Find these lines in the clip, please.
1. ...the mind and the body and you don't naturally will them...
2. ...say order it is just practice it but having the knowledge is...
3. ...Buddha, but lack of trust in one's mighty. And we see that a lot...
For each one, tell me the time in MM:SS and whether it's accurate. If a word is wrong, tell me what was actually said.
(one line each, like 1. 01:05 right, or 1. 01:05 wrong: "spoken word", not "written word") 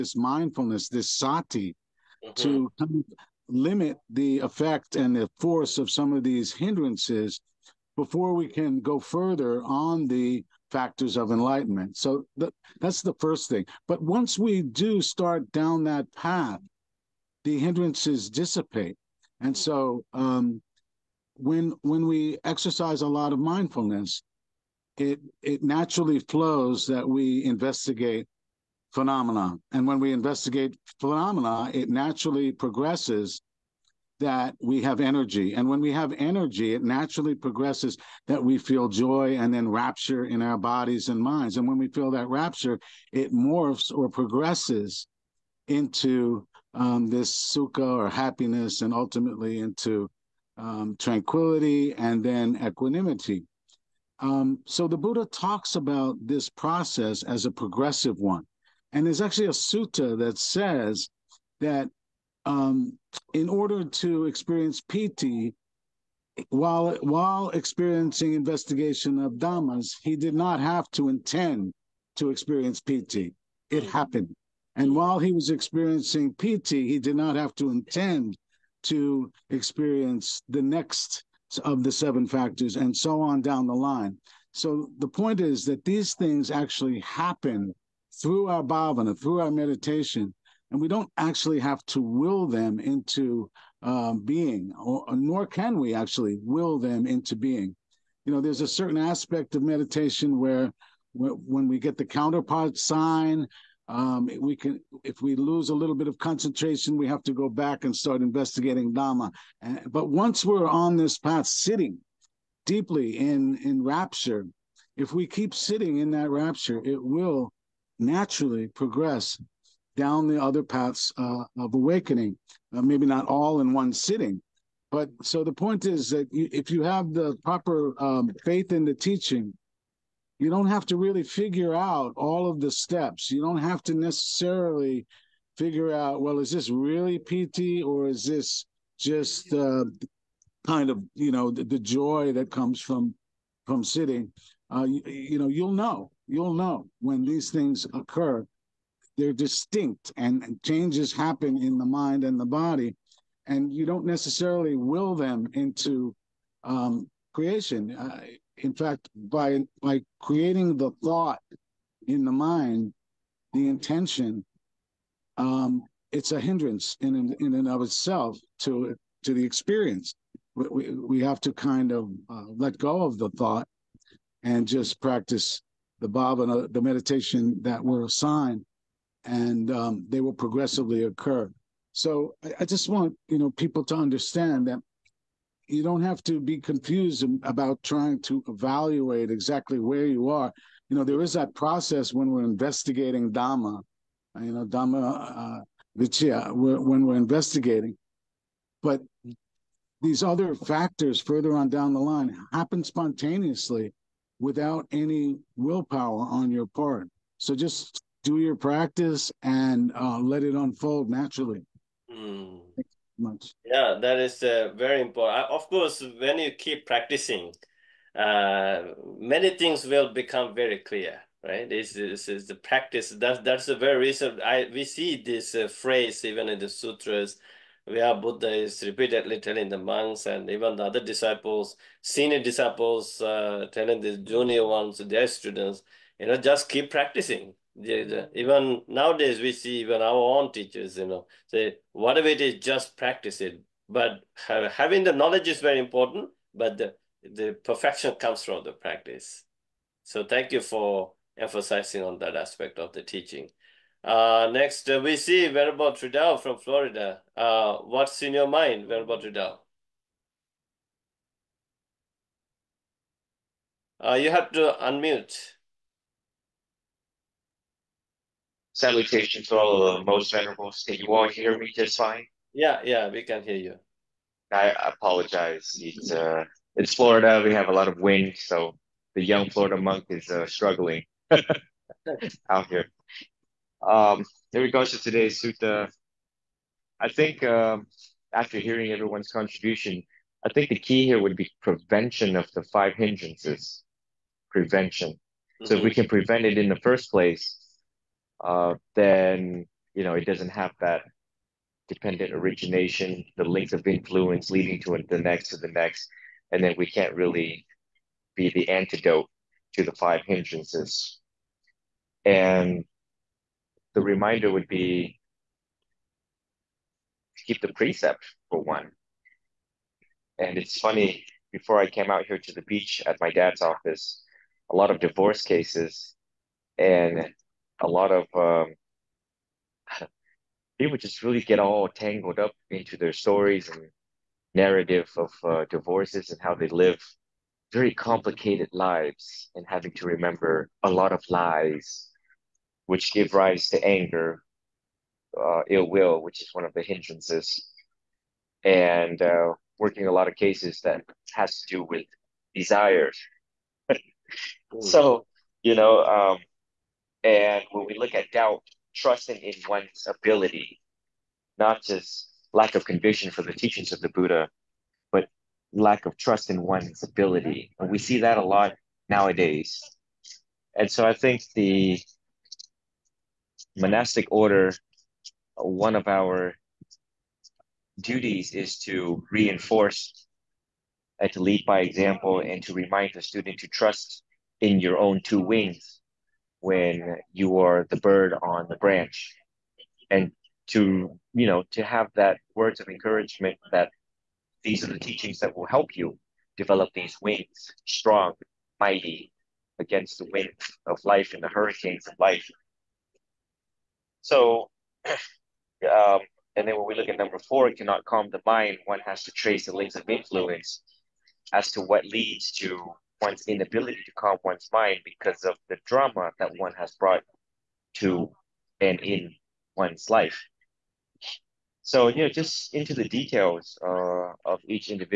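1. 02:31 wrong: "necessarily", not "naturally"
2. 04:01 wrong: "whatever", not "order"
3. 06:04 wrong: "ability", not "mighty".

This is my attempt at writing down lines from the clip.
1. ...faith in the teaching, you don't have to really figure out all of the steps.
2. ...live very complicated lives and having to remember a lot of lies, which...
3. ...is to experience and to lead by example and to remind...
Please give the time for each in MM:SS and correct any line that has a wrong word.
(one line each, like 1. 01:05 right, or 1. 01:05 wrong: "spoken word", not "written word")
1. 02:08 right
2. 05:36 right
3. 06:18 wrong: "reinforce", not "experience".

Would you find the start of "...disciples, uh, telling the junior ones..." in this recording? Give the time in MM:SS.
03:52.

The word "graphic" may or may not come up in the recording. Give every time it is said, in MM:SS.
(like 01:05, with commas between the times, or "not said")
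not said.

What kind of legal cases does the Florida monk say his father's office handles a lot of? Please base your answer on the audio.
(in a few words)
divorce cases.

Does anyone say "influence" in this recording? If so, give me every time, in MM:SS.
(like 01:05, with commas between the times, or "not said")
05:03, 06:50.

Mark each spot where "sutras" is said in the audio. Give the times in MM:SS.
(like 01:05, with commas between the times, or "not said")
03:46.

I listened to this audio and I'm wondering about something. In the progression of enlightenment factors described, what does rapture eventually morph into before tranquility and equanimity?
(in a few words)
sukha.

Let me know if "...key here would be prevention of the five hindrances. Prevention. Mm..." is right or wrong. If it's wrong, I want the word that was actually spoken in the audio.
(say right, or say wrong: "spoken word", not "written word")
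right.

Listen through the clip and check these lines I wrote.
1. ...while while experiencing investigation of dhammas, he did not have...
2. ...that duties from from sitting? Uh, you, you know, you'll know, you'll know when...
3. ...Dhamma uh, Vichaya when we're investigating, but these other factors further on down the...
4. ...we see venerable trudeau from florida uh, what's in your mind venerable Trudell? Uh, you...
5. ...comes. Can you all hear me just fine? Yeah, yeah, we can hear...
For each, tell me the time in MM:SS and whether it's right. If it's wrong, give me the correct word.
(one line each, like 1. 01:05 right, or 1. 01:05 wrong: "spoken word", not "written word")
1. 01:06 right
2. 02:22 wrong: "comes", not "duties"
3. 03:14 right
4. 04:15 right
5. 04:30 wrong: "venerables", not "comes".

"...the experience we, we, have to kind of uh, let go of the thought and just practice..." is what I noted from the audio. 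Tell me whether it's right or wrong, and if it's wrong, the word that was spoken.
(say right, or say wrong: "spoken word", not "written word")
right.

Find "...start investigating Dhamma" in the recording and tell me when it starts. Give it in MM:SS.
01:47.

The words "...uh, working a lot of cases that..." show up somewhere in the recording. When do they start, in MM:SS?
05:49.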